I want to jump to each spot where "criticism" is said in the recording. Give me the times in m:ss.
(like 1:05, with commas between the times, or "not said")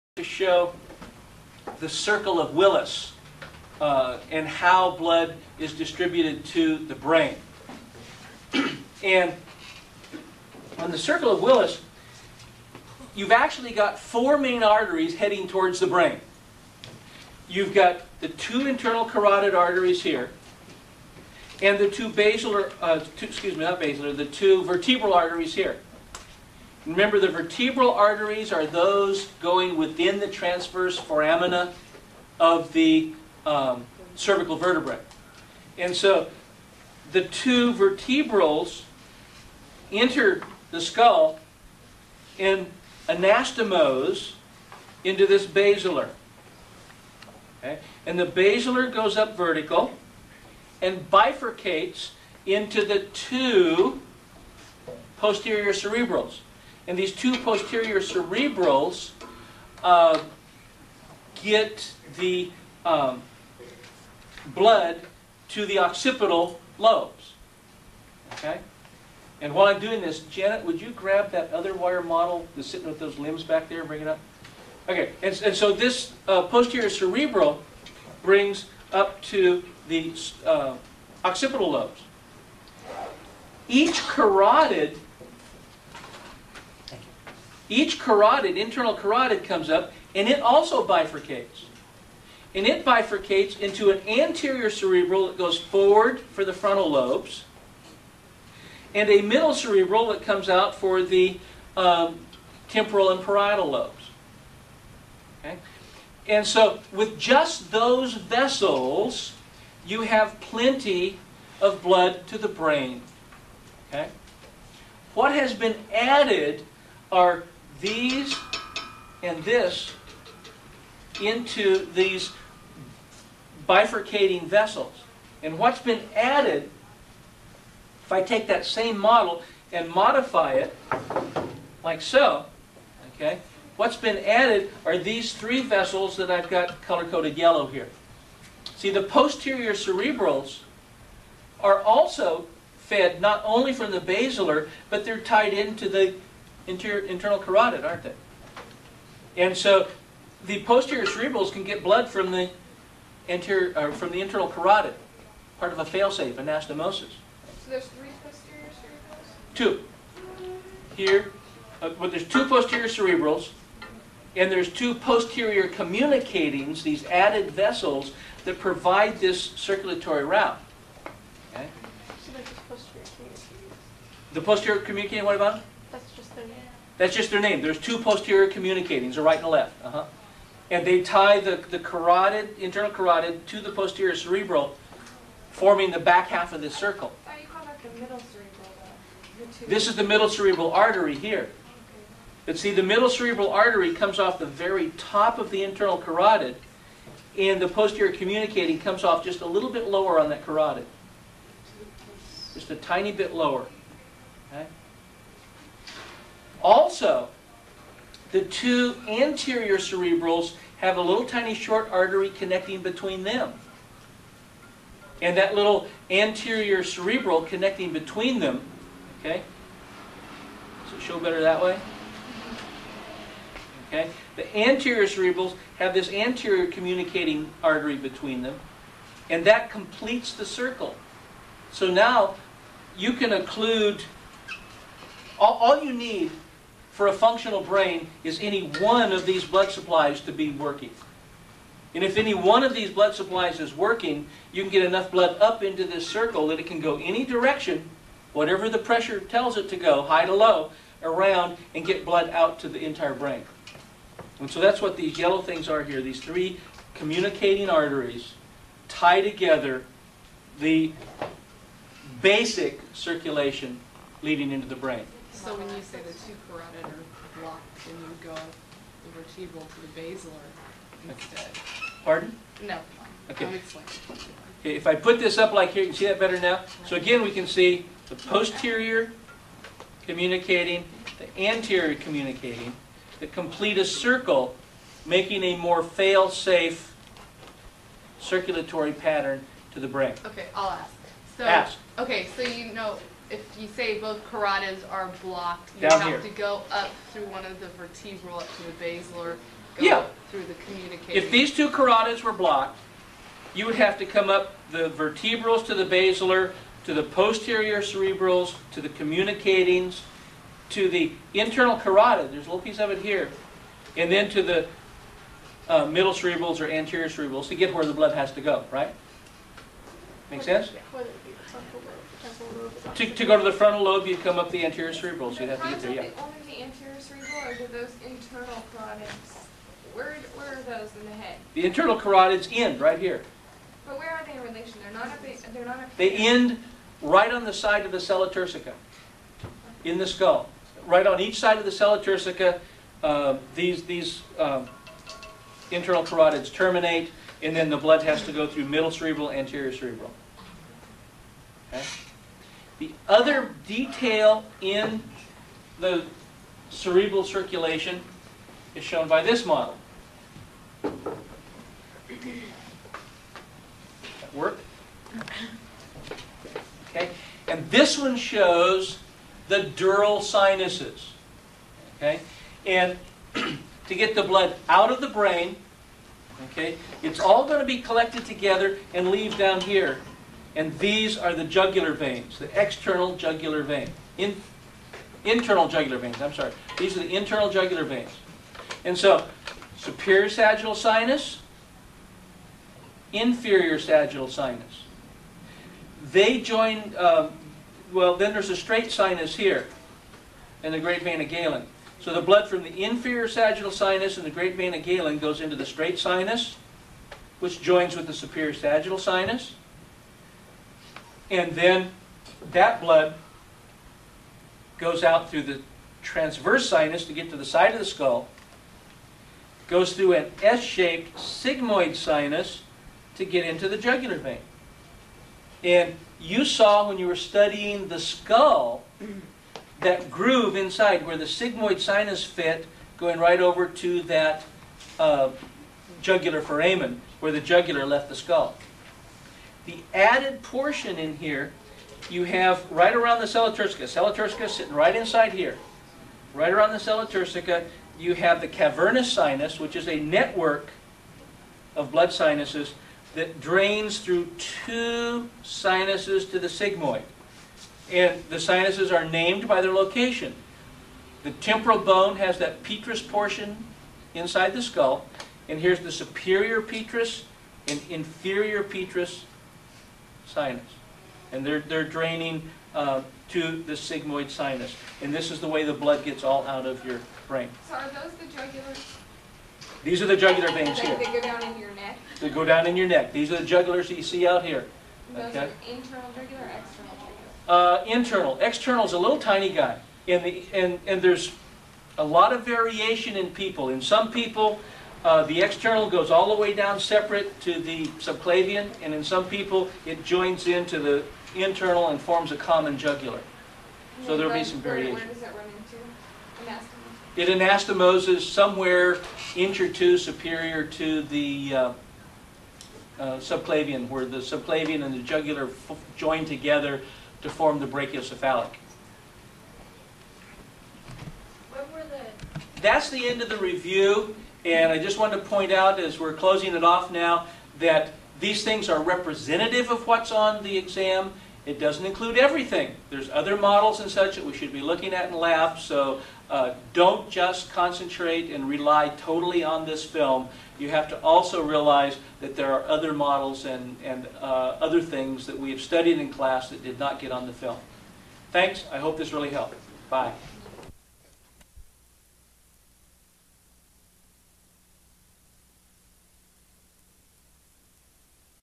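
not said.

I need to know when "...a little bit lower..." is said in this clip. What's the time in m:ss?
3:19.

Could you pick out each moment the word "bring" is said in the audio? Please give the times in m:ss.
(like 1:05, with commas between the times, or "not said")
1:13, 1:18.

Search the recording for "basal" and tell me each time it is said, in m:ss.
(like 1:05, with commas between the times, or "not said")
4:58.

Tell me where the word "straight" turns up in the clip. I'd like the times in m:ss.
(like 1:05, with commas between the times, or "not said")
6:38, 6:45.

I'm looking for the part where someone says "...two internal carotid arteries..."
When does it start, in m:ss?
0:18.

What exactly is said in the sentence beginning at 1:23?
Each carotid each carotid, internal carotid, comes up and it also bifurcates.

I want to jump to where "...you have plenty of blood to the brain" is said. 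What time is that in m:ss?
1:49.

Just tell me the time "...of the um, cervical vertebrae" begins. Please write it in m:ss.
0:32.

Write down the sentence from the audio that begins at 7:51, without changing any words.
And they're, they're draining uh, to the sigmoid sinus.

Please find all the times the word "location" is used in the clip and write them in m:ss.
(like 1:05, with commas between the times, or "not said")
7:39.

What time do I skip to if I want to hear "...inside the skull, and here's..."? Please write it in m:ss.
7:44.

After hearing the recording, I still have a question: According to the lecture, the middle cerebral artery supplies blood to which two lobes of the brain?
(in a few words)
temporal and parietal.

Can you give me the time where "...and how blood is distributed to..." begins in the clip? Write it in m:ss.
0:04.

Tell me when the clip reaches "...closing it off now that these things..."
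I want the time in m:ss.
8:46.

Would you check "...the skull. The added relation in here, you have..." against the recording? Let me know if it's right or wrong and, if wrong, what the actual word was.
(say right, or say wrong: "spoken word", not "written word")
wrong: "portion", not "relation".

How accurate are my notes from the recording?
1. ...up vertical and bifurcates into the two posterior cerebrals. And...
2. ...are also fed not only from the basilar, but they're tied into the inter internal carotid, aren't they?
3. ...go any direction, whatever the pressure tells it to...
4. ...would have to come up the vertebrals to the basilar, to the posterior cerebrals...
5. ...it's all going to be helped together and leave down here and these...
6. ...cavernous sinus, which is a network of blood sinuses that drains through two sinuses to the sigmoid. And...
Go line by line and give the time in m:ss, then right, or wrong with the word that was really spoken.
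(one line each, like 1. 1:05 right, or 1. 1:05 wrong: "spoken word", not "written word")
1. 0:49 right
2. 2:21 right
3. 4:06 right
4. 5:03 right
5. 6:17 wrong: "collected", not "helped"
6. 7:28 right.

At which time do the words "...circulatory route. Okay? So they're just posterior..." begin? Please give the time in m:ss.
2:49.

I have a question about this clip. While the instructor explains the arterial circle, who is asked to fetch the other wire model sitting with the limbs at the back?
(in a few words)
Janet.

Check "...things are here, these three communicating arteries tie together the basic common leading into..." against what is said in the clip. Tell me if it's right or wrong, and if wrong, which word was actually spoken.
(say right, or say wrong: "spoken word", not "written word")
wrong: "circulation", not "common".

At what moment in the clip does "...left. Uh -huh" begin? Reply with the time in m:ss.
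2:59.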